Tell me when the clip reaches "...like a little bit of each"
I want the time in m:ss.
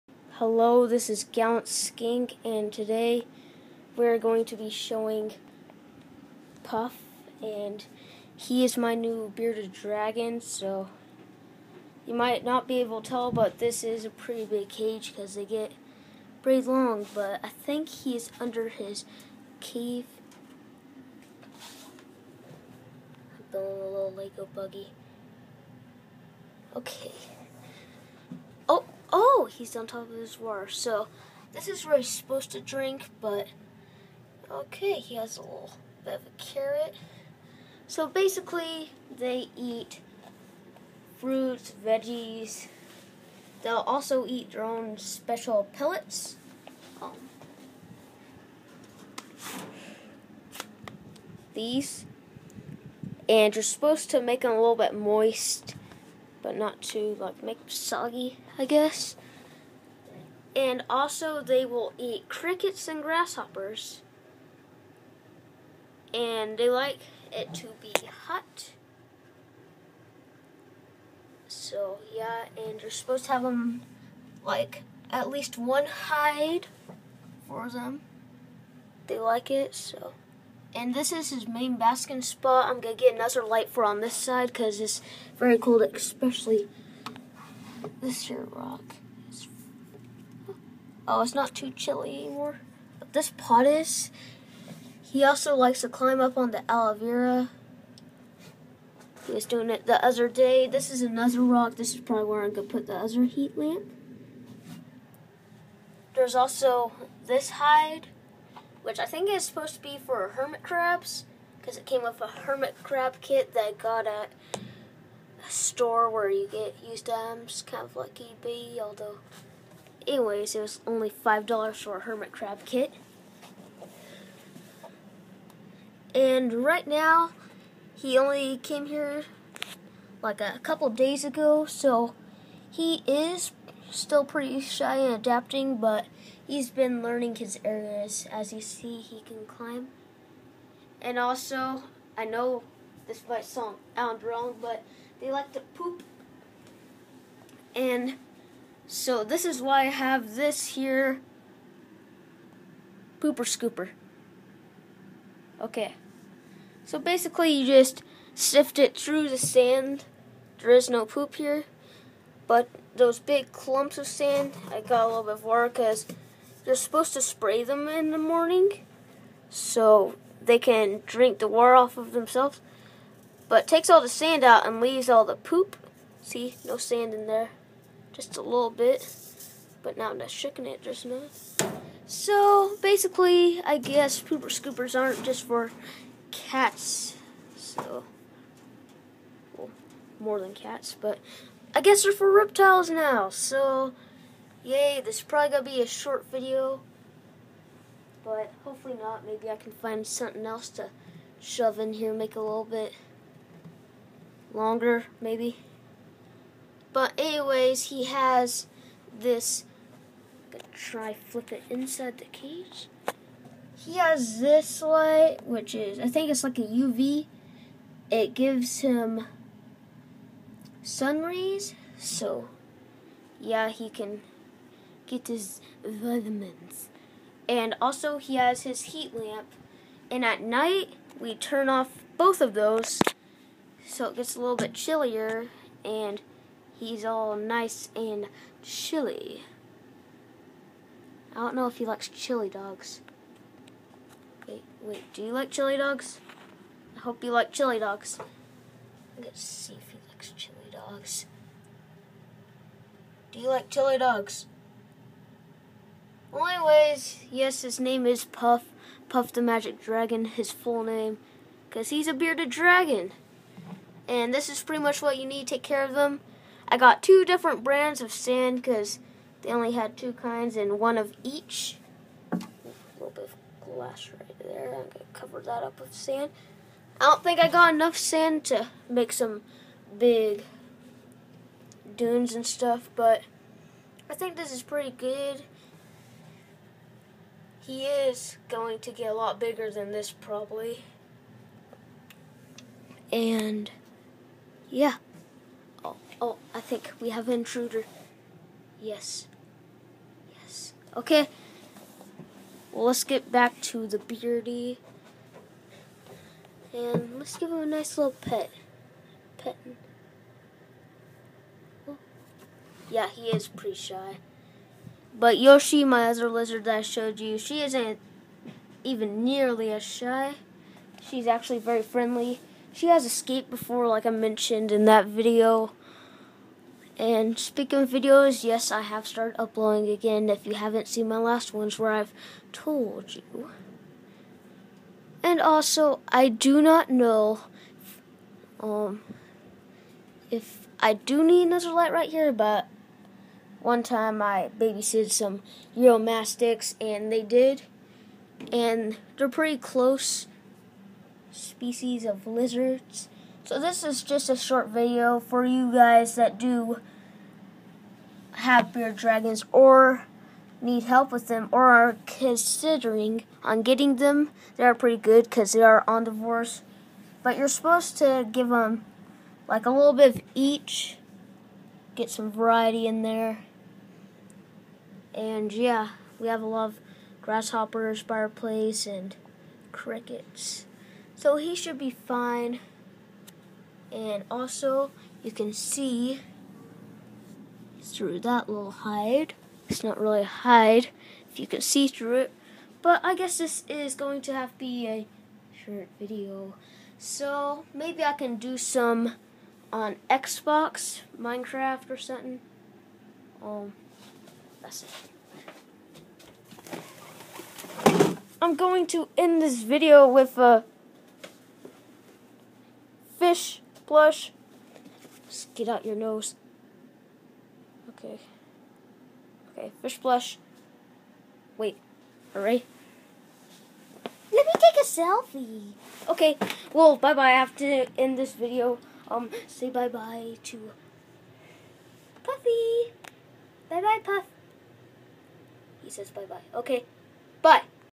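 6:09.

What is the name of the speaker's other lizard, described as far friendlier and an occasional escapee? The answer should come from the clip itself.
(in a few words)
Yoshi.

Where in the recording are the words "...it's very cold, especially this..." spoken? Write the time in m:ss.
1:24.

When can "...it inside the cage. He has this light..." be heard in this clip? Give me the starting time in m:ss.
3:31.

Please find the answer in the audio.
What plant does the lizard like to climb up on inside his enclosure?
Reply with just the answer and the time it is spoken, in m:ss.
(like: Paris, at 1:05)
aloe vera, at 1:36.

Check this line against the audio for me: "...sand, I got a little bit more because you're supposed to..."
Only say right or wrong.
right.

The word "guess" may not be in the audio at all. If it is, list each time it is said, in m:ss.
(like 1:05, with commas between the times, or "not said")
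0:58, 3:03, 3:11, 6:33.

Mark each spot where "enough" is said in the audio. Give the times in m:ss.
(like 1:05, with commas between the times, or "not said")
3:01, 4:37.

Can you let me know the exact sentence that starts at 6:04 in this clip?
They are pretty good because they are on omnivores.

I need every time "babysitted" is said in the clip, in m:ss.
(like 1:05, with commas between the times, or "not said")
5:44.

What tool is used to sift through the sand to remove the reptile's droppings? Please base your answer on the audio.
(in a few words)
pooper scooper.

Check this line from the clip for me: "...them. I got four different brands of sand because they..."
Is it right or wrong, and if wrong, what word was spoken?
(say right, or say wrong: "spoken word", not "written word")
wrong: "two", not "four".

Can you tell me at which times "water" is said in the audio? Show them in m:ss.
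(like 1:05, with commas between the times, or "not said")
0:30, 2:51.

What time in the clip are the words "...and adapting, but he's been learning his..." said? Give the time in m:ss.
2:14.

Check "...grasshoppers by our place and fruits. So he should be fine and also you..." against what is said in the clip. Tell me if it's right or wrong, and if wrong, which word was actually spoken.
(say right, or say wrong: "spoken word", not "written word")
wrong: "crickets", not "fruits".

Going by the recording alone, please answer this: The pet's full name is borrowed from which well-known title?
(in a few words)
Puff the Magic Dragon.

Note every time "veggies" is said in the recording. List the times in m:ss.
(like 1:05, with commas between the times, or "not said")
0:41.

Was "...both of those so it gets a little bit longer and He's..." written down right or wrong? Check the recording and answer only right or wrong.
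wrong.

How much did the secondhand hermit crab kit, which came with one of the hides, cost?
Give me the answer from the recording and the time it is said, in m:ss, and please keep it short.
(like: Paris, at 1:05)
$5, at 2:01.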